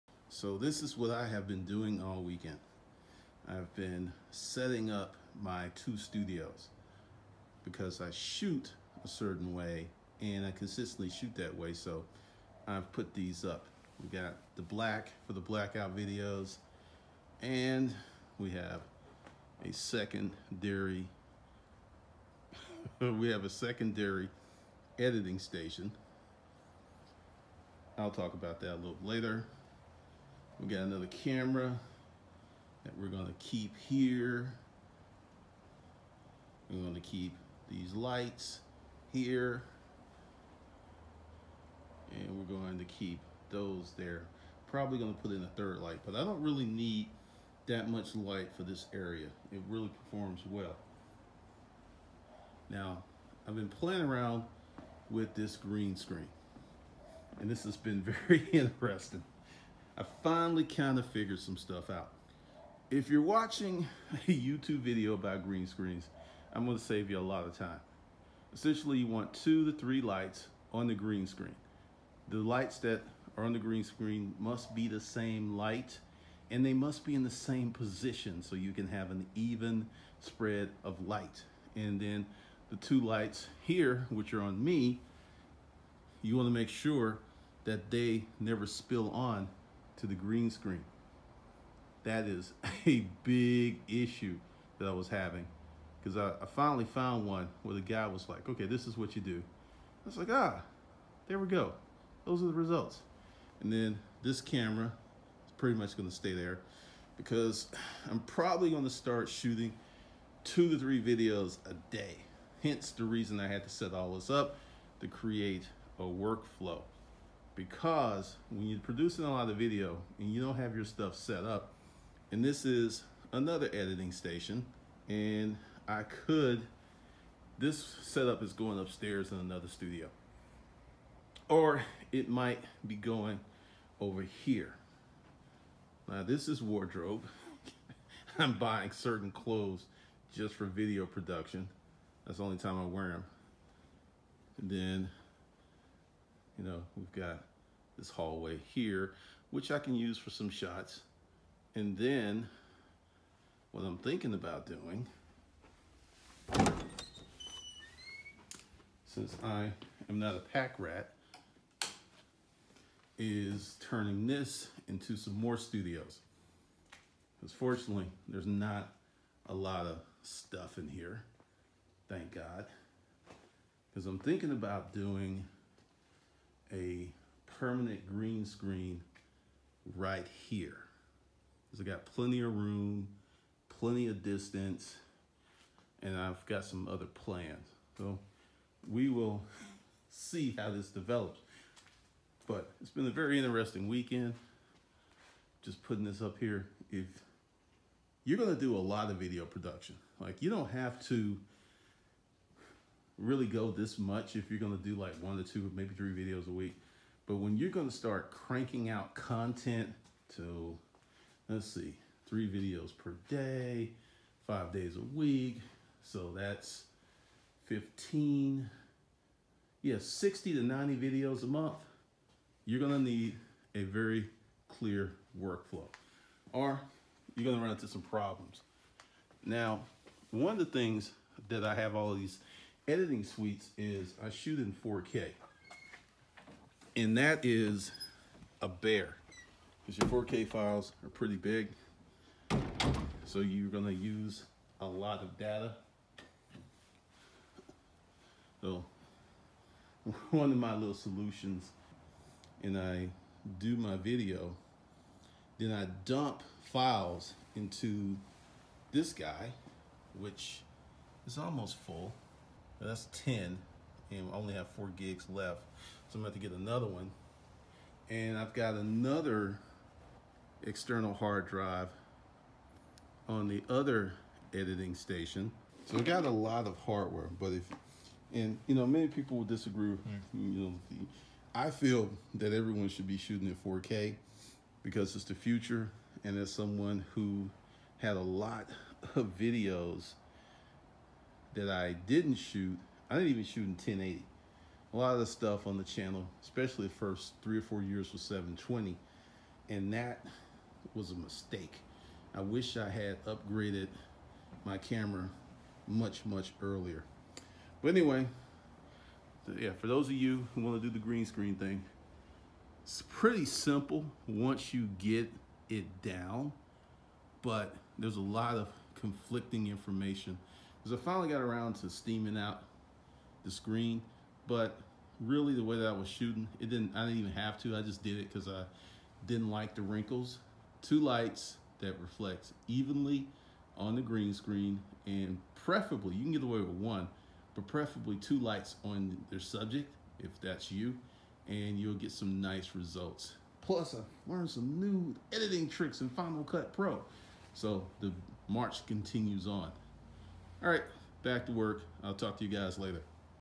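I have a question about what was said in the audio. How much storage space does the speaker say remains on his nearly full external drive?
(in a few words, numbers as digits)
4 gigs.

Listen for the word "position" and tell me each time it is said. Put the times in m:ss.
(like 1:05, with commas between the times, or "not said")
1:17.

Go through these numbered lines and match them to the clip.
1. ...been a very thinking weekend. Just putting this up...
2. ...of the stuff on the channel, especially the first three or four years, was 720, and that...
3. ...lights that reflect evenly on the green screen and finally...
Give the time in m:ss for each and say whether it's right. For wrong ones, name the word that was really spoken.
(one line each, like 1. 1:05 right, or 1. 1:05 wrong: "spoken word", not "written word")
1. 3:12 wrong: "interesting", not "thinking"
2. 4:55 right
3. 5:30 wrong: "preferably", not "finally".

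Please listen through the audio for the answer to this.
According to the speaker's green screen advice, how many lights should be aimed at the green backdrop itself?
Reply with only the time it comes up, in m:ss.
1:09.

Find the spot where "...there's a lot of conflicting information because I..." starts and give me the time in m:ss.
5:17.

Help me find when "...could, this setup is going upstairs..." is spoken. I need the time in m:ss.
2:06.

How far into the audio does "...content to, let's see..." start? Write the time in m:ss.
3:29.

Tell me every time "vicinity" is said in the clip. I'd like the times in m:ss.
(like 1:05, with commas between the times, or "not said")
not said.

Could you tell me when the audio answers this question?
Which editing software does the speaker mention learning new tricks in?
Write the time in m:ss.
5:46.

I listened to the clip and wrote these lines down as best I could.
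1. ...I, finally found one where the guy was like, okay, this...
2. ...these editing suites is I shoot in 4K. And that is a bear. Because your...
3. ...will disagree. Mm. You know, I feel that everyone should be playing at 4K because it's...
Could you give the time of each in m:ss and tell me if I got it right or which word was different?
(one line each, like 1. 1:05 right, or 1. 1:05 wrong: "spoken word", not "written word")
1. 1:36 right
2. 3:52 right
3. 4:39 wrong: "shooting", not "playing".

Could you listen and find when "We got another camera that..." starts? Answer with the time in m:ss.
0:30.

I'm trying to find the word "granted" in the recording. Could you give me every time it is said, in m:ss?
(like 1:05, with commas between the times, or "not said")
not said.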